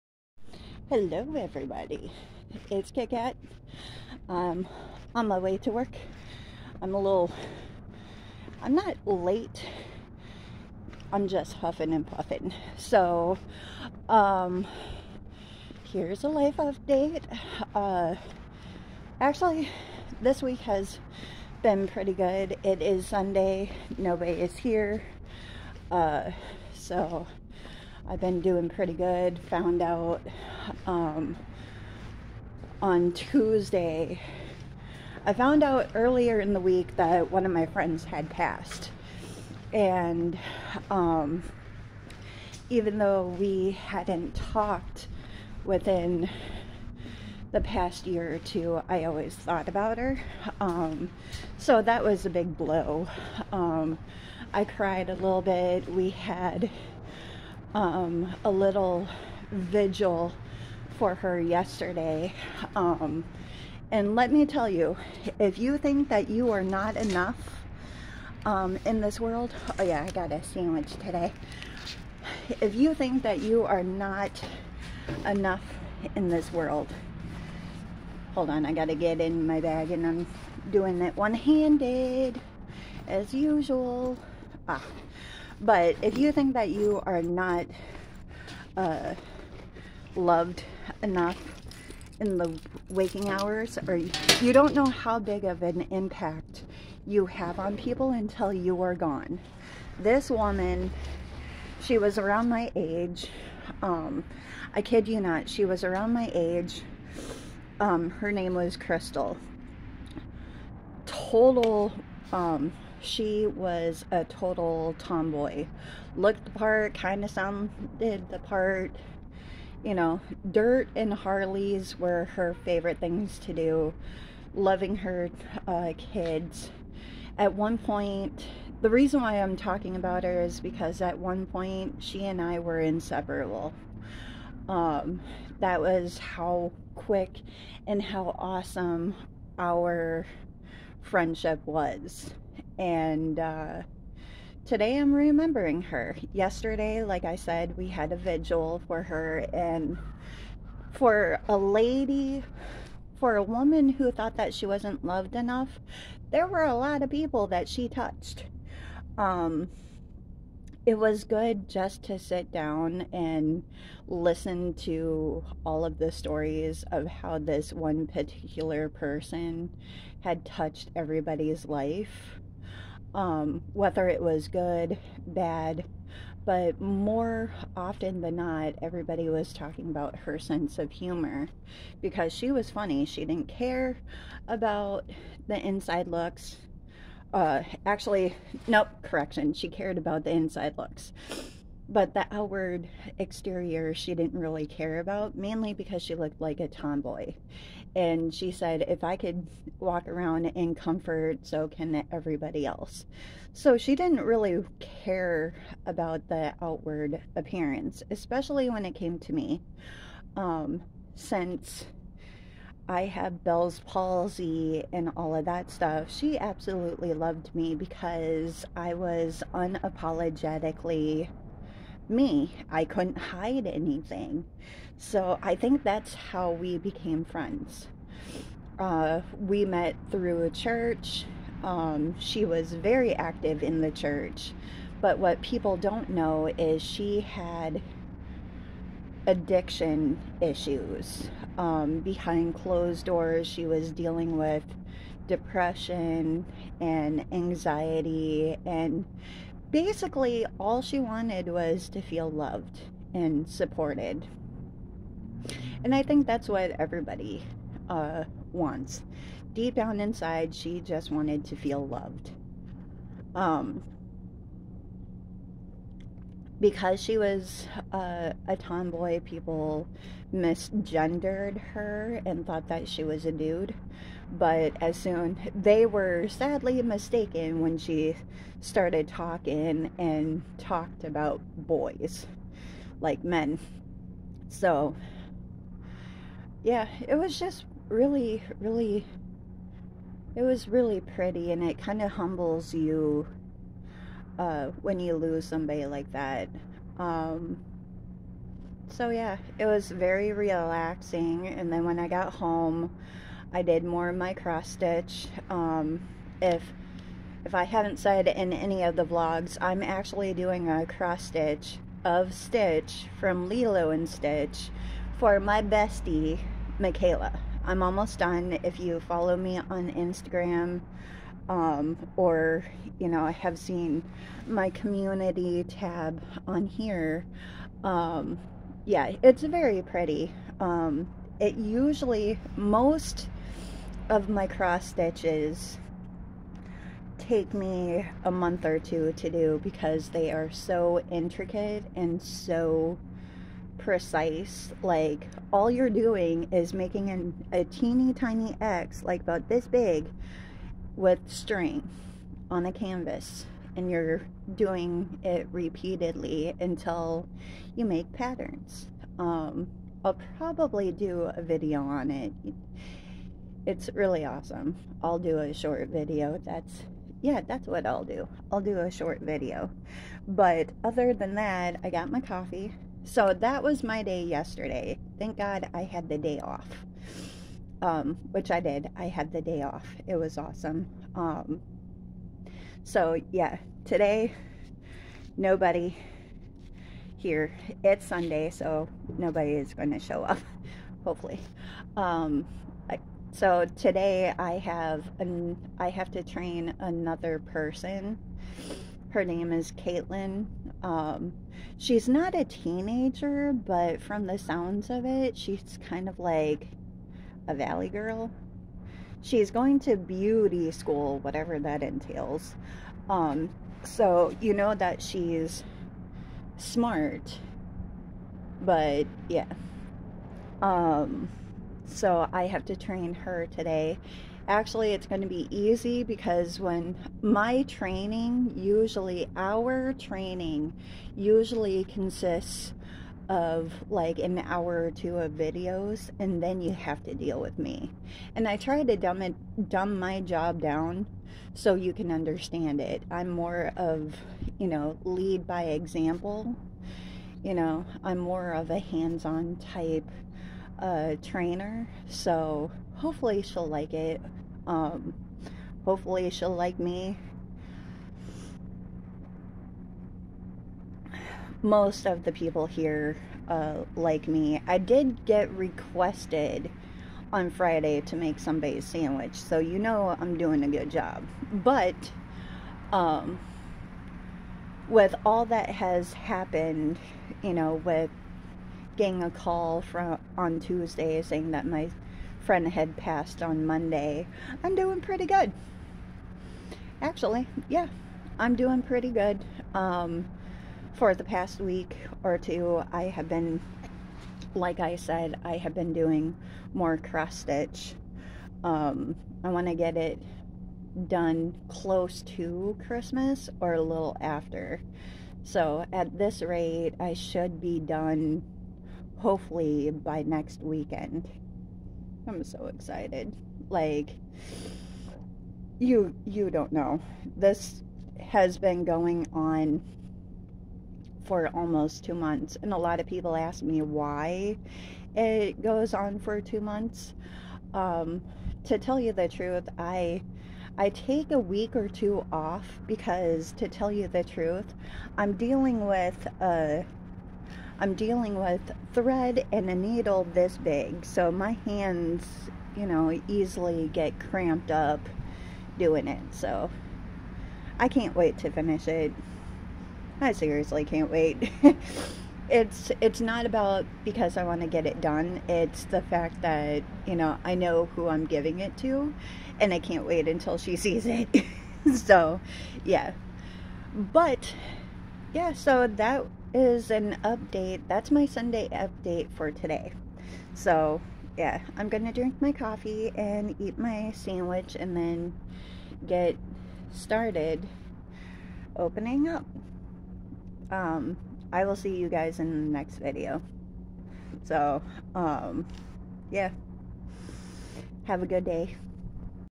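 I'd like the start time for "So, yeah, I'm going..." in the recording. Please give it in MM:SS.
09:30.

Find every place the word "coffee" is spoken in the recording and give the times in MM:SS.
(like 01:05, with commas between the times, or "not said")
06:12, 09:32.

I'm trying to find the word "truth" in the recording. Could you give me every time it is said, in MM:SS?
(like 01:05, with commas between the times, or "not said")
08:49, 08:54.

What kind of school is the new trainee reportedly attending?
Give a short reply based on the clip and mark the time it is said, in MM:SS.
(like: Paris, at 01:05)
Beauty school, at 06:49.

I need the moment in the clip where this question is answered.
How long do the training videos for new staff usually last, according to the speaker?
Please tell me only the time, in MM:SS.
07:14.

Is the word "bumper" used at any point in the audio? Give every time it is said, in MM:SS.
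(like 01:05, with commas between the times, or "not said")
not said.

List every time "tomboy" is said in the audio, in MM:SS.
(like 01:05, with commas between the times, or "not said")
01:54, 03:16, 04:28.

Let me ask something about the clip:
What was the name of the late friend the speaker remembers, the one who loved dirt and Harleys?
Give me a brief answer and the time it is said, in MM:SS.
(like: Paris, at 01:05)
Crystal, at 01:48.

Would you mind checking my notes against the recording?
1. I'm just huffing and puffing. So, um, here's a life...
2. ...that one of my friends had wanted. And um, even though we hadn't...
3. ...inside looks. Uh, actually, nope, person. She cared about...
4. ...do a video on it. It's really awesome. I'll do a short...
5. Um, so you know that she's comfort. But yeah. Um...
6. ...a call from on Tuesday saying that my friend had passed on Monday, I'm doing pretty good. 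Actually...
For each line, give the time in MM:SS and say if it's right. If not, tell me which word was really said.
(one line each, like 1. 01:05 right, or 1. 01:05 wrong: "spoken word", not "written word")
1. 00:11 right
2. 00:36 wrong: "passed", not "wanted"
3. 03:05 wrong: "correction", not "person"
4. 06:00 right
5. 06:53 wrong: "smart", not "comfort"
6. 07:59 right.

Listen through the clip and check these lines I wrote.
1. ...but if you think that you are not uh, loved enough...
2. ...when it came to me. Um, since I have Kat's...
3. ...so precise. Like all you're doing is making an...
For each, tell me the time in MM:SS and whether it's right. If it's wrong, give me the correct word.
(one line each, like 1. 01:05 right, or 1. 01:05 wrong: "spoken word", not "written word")
1. 01:25 right
2. 03:28 wrong: "Bell", not "Kat"
3. 05:42 right.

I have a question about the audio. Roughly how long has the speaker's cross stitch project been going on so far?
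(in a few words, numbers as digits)
Almost 2 months.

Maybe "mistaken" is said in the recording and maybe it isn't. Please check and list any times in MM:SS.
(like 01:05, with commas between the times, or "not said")
04:36.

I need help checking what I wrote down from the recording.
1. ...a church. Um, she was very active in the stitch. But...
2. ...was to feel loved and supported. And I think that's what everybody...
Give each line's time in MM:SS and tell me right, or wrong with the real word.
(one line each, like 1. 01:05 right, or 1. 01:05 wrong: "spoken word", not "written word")
1. 03:50 wrong: "church", not "stitch"
2. 04:11 right.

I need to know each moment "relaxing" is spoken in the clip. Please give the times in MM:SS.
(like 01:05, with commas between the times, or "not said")
05:00.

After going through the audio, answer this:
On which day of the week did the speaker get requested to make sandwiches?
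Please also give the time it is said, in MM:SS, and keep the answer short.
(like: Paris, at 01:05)
Friday, at 07:47.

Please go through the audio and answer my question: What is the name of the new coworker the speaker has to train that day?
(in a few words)
Caitlin.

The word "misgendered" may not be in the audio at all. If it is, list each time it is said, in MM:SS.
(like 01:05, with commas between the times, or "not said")
04:30.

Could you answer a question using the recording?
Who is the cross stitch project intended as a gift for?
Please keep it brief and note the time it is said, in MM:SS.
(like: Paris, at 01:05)
Michaela, at 05:16.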